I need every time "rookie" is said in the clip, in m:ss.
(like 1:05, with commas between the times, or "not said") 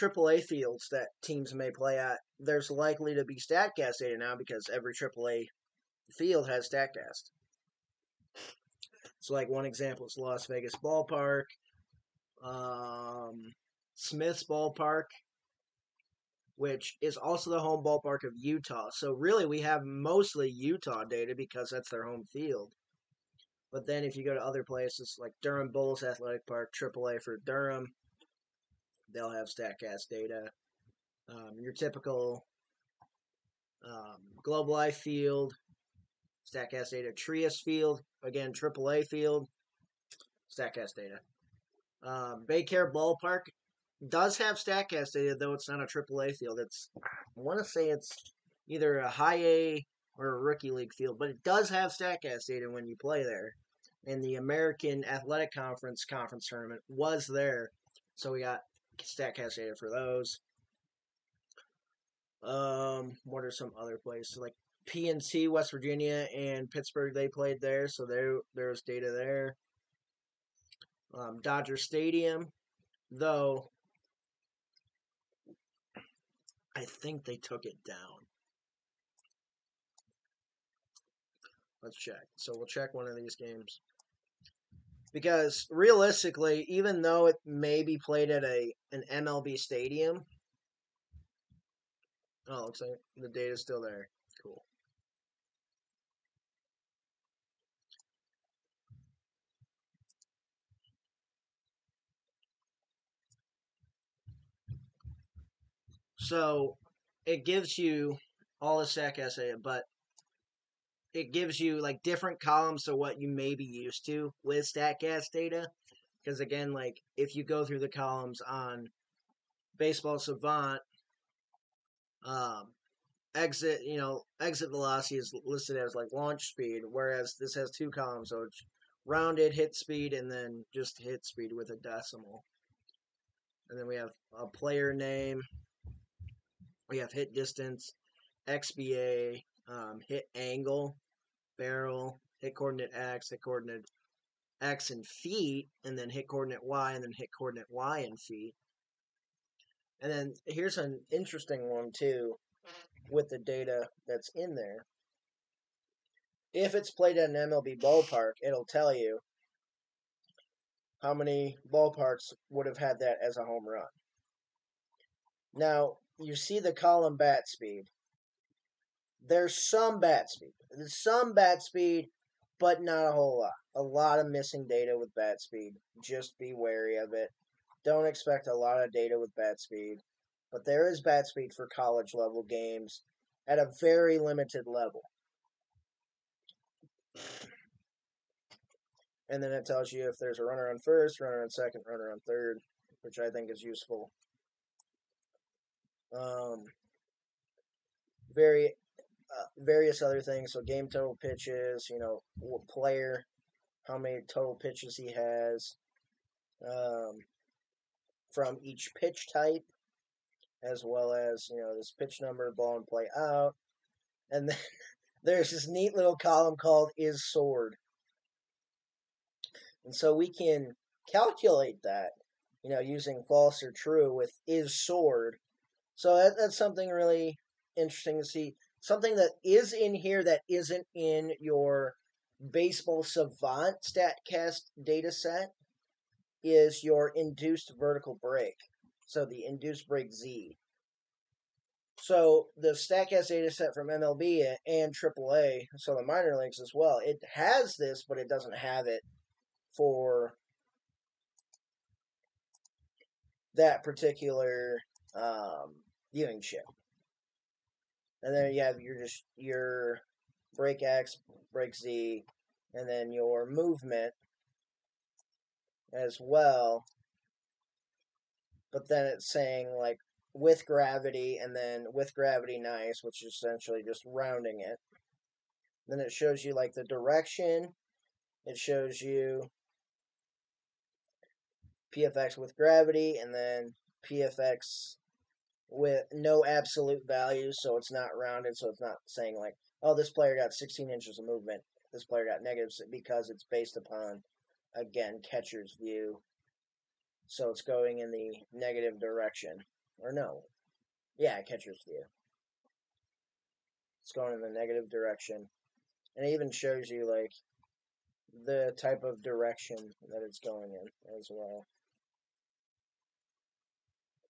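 0:50.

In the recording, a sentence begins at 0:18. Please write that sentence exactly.
So really, we have mostly Utah data because that's their home field.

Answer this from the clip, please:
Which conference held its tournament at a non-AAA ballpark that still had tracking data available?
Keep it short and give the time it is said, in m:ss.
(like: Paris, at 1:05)
American Athletic Conference, at 0:54.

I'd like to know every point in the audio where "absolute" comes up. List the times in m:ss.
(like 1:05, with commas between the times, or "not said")
4:46.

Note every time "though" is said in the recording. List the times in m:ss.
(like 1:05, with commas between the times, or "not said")
0:45, 1:13, 1:26.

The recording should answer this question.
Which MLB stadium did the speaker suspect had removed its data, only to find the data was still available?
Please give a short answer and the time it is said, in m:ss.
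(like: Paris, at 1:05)
Dodger Stadium, at 1:11.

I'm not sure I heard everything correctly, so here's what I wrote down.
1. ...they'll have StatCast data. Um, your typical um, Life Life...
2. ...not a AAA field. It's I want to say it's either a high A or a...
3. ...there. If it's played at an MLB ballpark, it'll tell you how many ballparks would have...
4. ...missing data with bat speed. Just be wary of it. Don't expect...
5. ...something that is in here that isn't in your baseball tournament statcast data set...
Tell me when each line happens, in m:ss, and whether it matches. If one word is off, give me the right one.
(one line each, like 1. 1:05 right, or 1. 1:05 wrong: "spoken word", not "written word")
1. 0:29 wrong: "Globe", not "Life"
2. 0:45 right
3. 2:34 right
4. 2:54 right
5. 3:48 wrong: "savant", not "tournament".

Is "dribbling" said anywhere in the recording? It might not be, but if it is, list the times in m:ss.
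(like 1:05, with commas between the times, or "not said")
not said.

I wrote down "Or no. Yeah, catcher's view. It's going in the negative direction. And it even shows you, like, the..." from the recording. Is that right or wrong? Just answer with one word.
right.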